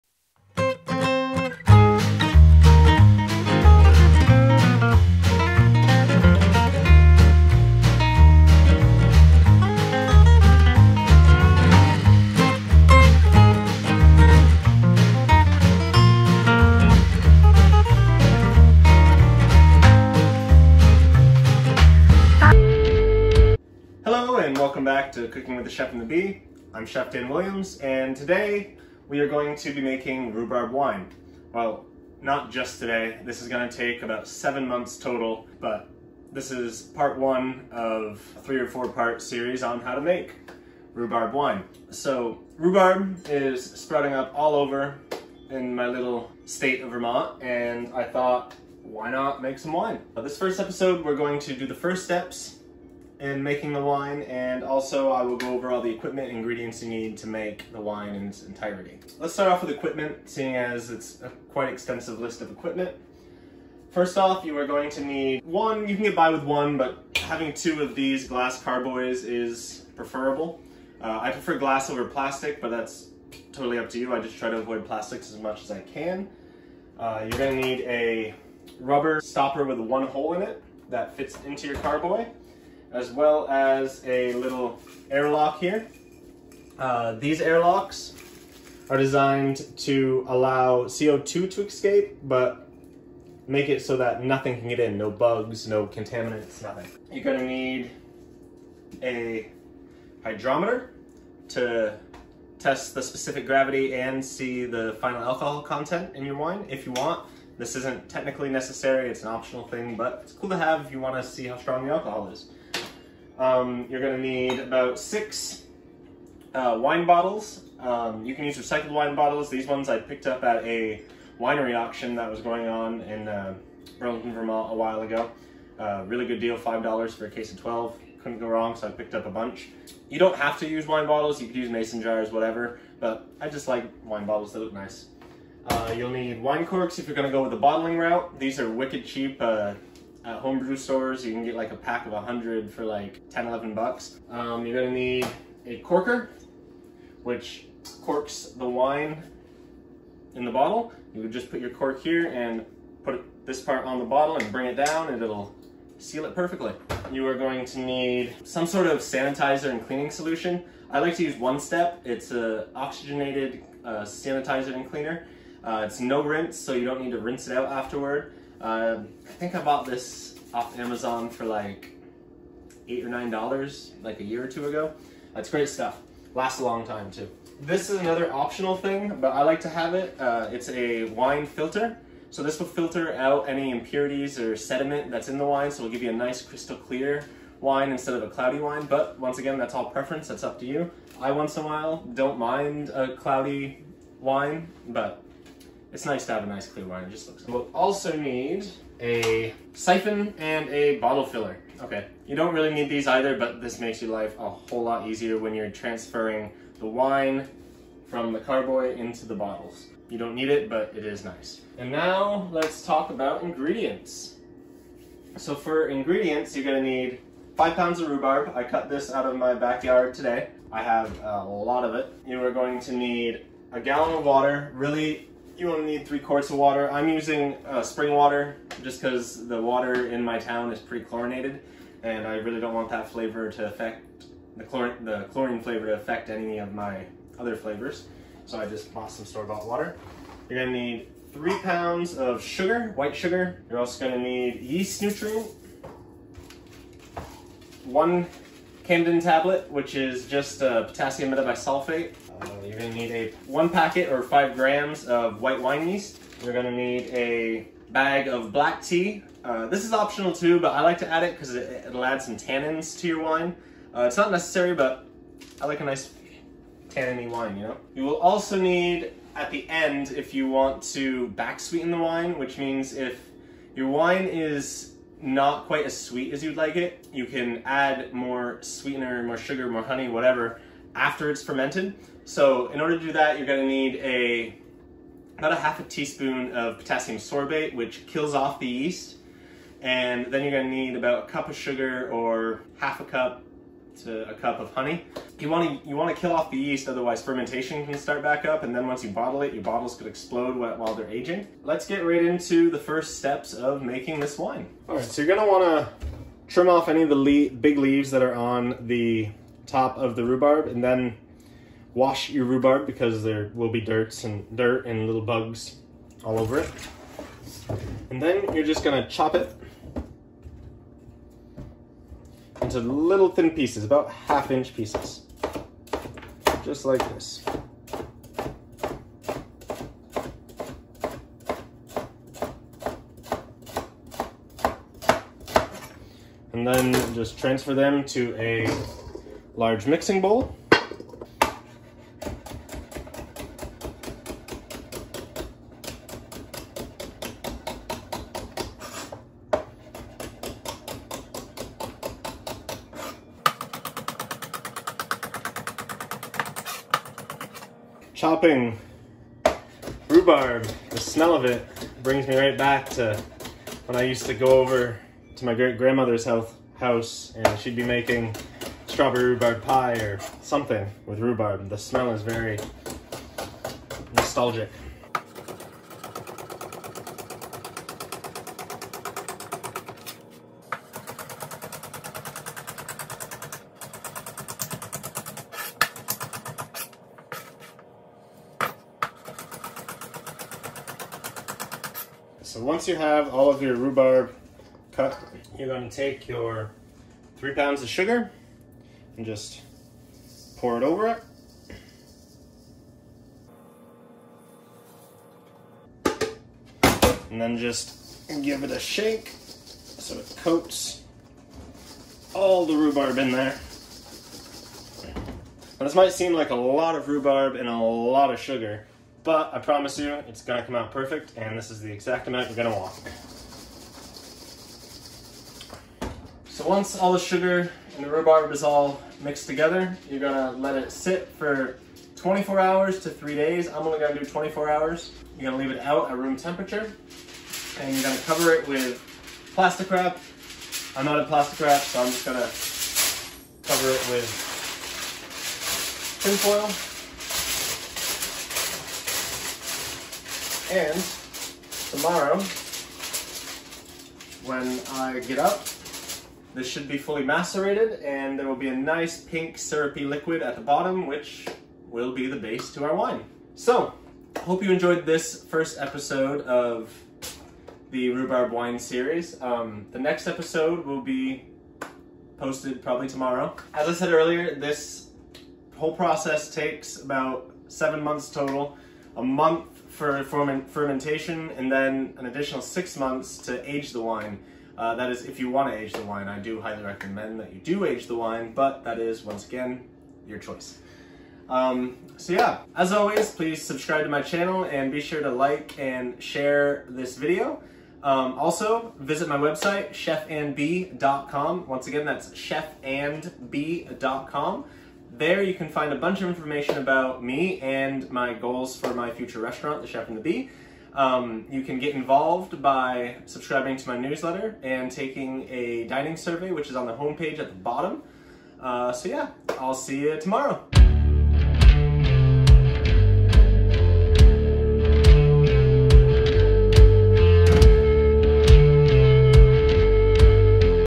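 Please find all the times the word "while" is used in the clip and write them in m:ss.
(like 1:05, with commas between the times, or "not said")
2:04, 3:11, 5:00.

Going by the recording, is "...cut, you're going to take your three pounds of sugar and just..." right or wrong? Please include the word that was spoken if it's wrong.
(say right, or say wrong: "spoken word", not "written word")
right.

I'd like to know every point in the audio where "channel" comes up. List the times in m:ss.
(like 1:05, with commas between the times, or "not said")
8:14.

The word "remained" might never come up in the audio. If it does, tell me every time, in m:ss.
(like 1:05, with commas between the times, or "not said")
not said.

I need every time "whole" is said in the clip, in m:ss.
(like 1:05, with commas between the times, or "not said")
3:24, 7:55.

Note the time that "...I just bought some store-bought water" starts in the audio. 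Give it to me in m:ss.
3:58.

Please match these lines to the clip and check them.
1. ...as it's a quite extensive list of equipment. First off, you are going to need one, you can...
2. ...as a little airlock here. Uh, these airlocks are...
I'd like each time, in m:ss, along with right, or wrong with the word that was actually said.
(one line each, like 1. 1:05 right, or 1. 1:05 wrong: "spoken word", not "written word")
1. 1:00 right
2. 1:23 right.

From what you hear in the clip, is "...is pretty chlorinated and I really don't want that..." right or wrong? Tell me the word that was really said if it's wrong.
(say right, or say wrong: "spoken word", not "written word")
right.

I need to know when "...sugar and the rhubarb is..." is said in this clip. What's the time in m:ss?
7:07.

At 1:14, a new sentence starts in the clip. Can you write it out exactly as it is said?
I just try to avoid plastics as much as I can.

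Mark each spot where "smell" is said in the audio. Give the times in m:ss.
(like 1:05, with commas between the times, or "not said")
6:00, 6:11.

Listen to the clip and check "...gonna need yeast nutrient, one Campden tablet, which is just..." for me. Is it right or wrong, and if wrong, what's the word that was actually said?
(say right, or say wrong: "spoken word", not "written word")
right.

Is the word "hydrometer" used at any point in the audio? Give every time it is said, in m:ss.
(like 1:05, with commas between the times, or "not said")
1:40.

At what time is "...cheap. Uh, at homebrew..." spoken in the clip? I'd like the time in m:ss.
2:19.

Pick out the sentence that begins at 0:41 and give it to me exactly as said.
So rhubarb is sprouting up all over in my little state of Vermont, and I thought, why not make some wine?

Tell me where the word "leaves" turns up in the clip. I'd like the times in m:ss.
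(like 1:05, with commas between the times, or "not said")
5:07, 7:15.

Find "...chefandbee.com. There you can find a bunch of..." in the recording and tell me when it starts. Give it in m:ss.
8:22.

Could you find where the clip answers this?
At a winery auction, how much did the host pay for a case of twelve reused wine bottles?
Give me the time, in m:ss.
2:06.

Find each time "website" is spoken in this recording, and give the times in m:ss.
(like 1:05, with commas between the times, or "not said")
8:19.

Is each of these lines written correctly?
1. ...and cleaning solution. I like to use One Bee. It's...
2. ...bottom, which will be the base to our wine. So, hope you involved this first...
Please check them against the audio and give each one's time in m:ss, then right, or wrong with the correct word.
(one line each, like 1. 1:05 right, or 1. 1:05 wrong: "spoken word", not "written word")
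1. 2:39 wrong: "Step", not "Bee"
2. 7:40 wrong: "enjoyed", not "involved".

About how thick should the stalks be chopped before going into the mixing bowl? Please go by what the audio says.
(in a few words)
half inch.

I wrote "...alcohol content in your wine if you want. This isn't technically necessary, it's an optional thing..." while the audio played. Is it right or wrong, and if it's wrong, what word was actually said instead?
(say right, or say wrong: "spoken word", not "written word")
right.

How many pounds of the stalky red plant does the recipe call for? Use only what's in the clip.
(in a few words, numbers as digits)
5 pounds.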